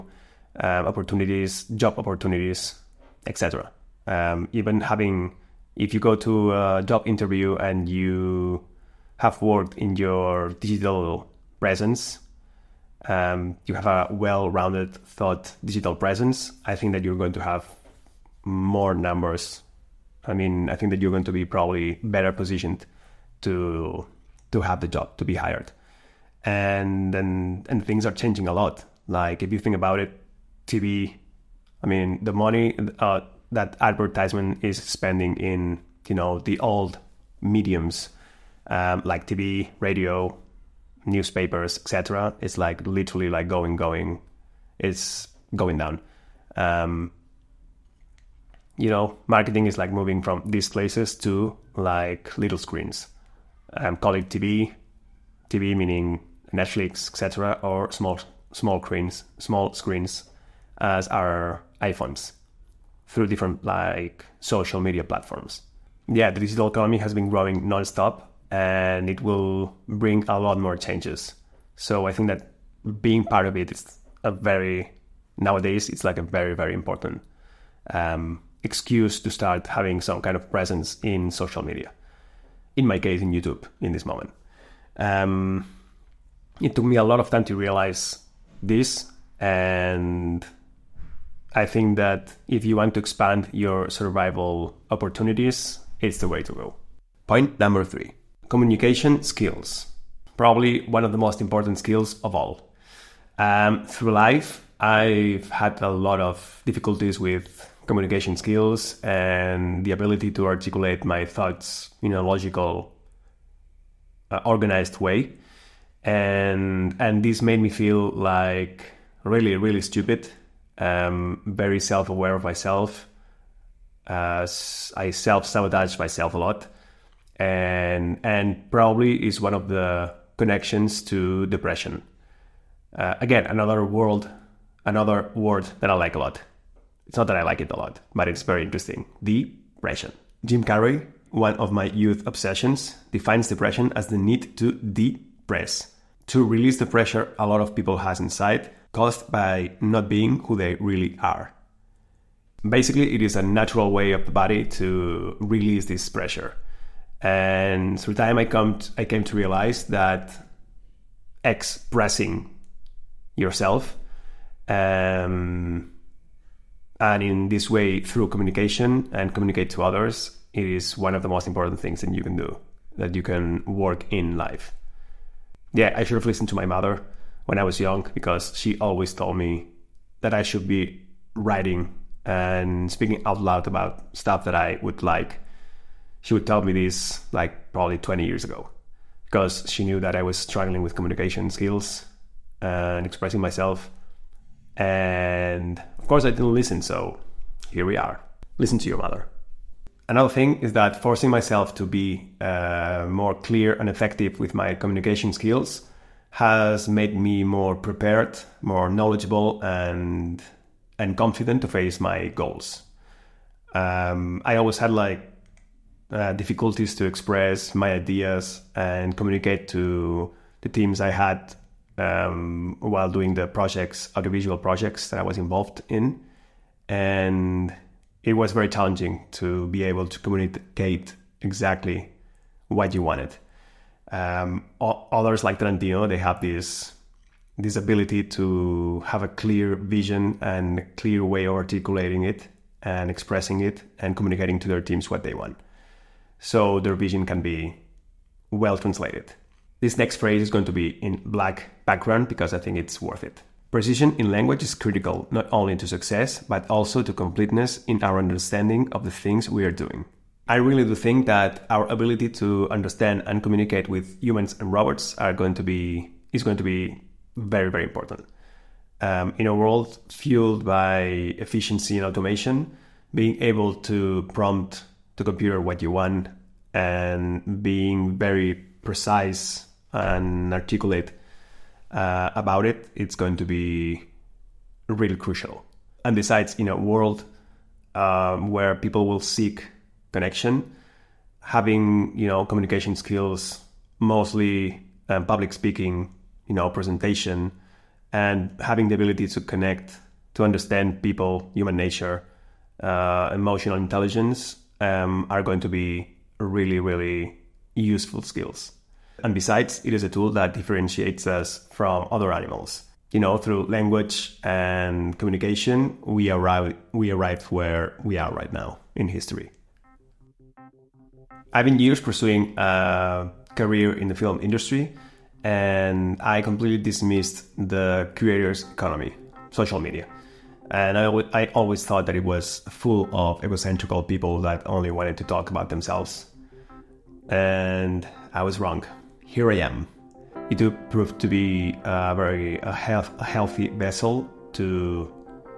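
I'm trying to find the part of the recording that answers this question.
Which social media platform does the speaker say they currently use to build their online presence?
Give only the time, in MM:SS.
01:23.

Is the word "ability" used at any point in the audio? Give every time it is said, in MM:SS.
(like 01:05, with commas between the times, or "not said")
01:49, 03:57, 04:21, 04:58.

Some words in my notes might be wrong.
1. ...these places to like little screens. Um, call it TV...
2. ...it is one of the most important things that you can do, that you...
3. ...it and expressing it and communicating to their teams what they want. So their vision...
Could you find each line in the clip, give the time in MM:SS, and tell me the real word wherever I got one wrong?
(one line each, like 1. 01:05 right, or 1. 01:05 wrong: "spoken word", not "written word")
1. 00:50 right
2. 02:50 right
3. 04:02 right.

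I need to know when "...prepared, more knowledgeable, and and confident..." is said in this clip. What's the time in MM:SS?
03:27.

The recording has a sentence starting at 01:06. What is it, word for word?
Yeah, the digital economy has been growing nonstop, and it will bring a lot more changes.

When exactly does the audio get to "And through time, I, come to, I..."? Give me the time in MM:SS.
02:37.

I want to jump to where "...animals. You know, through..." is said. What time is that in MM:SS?
05:12.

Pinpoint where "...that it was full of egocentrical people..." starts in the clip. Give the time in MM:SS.
05:32.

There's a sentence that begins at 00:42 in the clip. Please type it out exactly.
It's like literally like going, going, it's going down.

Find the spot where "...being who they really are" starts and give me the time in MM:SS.
02:30.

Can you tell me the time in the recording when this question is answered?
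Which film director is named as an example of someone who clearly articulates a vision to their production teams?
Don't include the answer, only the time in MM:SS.
03:55.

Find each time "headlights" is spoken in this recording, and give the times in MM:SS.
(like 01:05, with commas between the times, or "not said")
not said.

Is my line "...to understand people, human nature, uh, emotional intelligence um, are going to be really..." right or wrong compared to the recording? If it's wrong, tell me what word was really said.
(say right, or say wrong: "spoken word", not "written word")
right.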